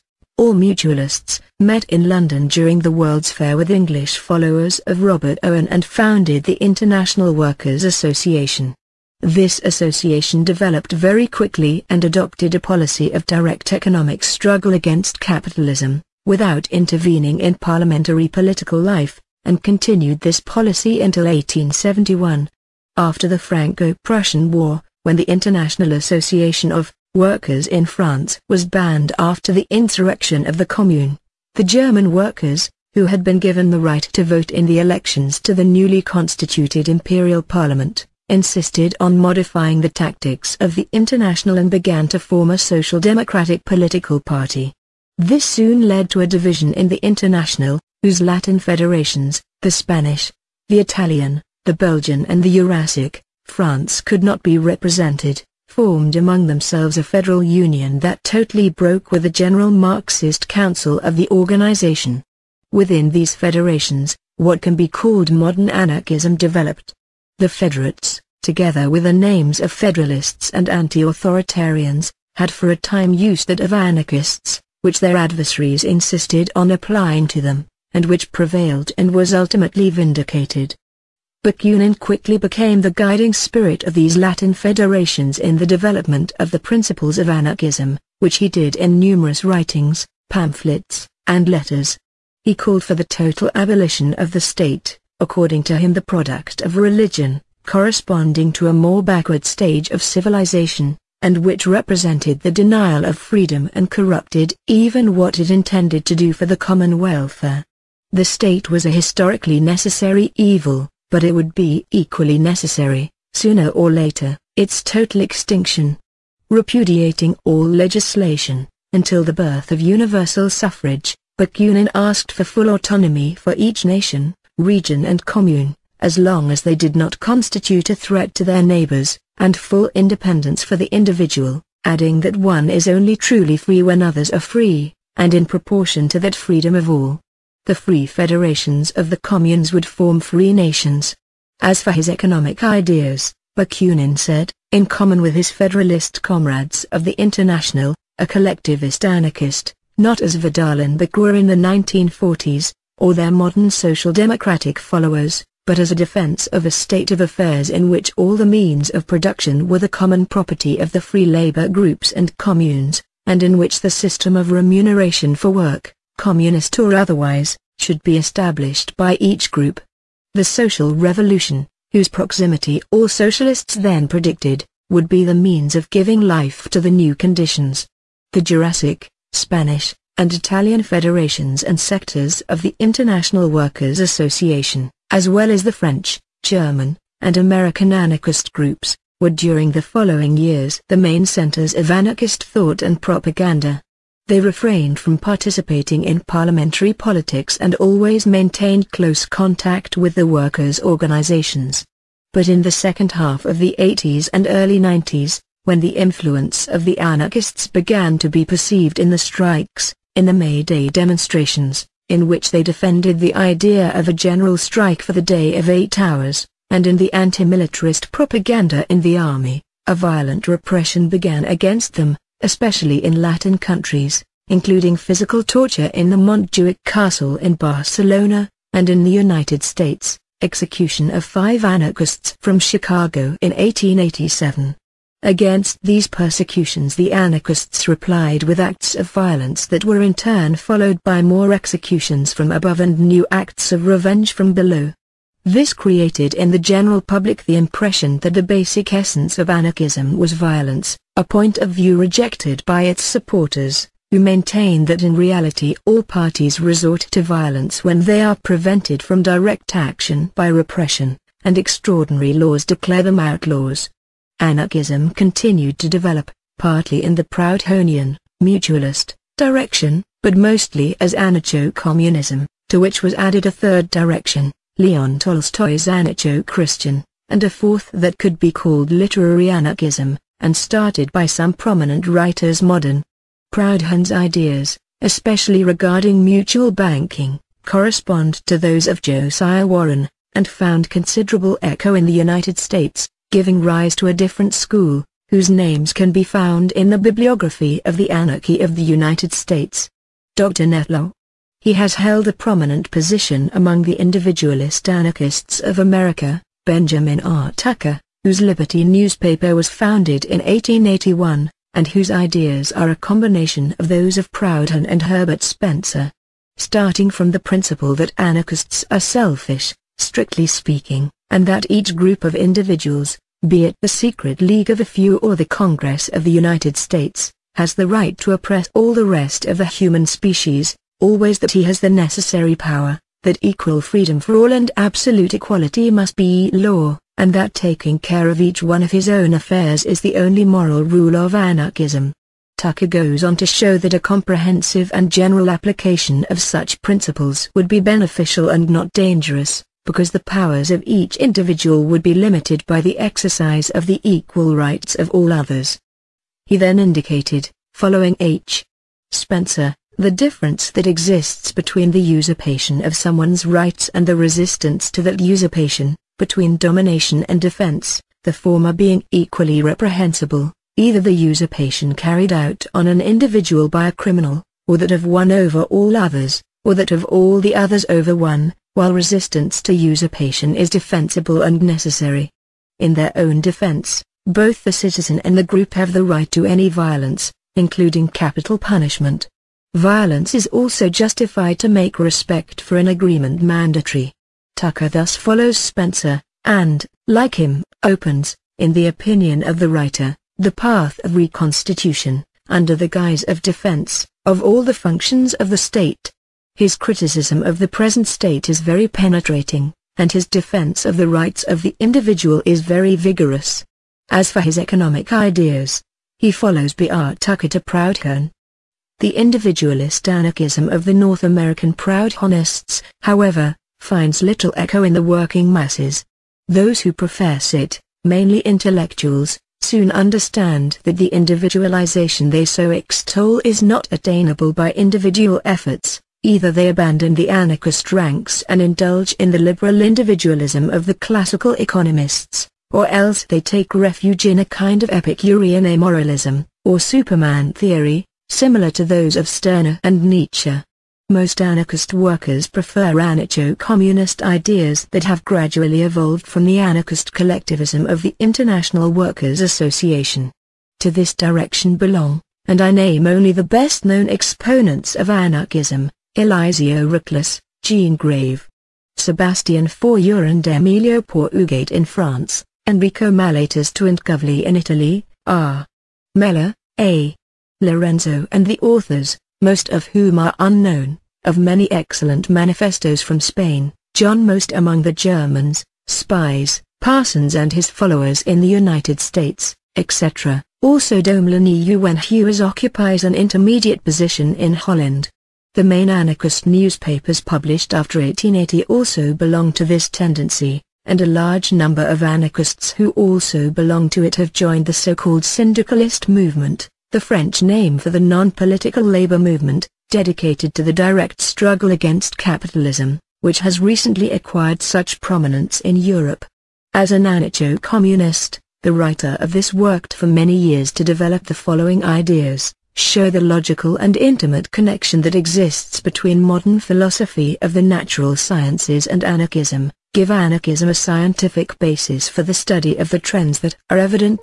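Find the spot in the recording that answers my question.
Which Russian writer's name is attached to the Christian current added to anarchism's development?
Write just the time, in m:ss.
4:34.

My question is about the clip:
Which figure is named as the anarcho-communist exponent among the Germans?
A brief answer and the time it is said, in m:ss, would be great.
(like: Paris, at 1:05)
John Most, at 8:03.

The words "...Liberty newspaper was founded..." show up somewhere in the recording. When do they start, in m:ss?
5:08.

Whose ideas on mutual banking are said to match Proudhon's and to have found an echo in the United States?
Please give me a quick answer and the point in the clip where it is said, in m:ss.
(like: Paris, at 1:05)
Josiah Warren, at 4:49.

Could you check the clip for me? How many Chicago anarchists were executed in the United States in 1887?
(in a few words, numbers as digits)
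5.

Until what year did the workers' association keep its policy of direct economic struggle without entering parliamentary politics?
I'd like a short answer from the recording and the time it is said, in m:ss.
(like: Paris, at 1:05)
1871, at 0:21.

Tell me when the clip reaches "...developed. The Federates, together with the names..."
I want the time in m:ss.
1:06.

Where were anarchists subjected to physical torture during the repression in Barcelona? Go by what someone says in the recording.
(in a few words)
Montjuic Castle.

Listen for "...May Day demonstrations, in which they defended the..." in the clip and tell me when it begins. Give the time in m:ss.
3:30.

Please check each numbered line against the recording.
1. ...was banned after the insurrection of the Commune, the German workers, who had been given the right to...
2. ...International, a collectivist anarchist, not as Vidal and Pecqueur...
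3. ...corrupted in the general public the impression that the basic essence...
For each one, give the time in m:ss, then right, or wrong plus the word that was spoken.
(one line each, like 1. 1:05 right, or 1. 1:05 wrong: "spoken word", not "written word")
1. 0:28 right
2. 2:27 right
3. 4:05 wrong: "created", not "corrupted".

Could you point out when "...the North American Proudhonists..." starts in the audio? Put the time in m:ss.
7:00.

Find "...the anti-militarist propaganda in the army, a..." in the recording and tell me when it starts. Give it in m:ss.
3:36.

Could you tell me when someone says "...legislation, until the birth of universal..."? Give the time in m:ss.
1:57.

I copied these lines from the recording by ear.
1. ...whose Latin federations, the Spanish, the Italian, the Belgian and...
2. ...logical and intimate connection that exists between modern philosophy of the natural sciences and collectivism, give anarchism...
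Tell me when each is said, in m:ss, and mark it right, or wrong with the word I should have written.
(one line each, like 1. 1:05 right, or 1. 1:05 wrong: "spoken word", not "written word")
1. 0:48 right
2. 8:43 wrong: "anarchism", not "collectivism".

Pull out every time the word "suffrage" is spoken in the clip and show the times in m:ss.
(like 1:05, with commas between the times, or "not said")
2:00.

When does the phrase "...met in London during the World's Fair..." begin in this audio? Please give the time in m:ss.
0:01.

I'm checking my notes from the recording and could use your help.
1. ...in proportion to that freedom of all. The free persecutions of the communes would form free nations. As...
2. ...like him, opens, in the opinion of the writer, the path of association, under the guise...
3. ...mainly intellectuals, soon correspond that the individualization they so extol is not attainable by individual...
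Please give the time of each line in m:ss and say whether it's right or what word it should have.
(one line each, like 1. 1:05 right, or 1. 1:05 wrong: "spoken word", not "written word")
1. 2:15 wrong: "federations", not "persecutions"
2. 6:37 wrong: "reconstitution", not "association"
3. 7:08 wrong: "understand", not "correspond".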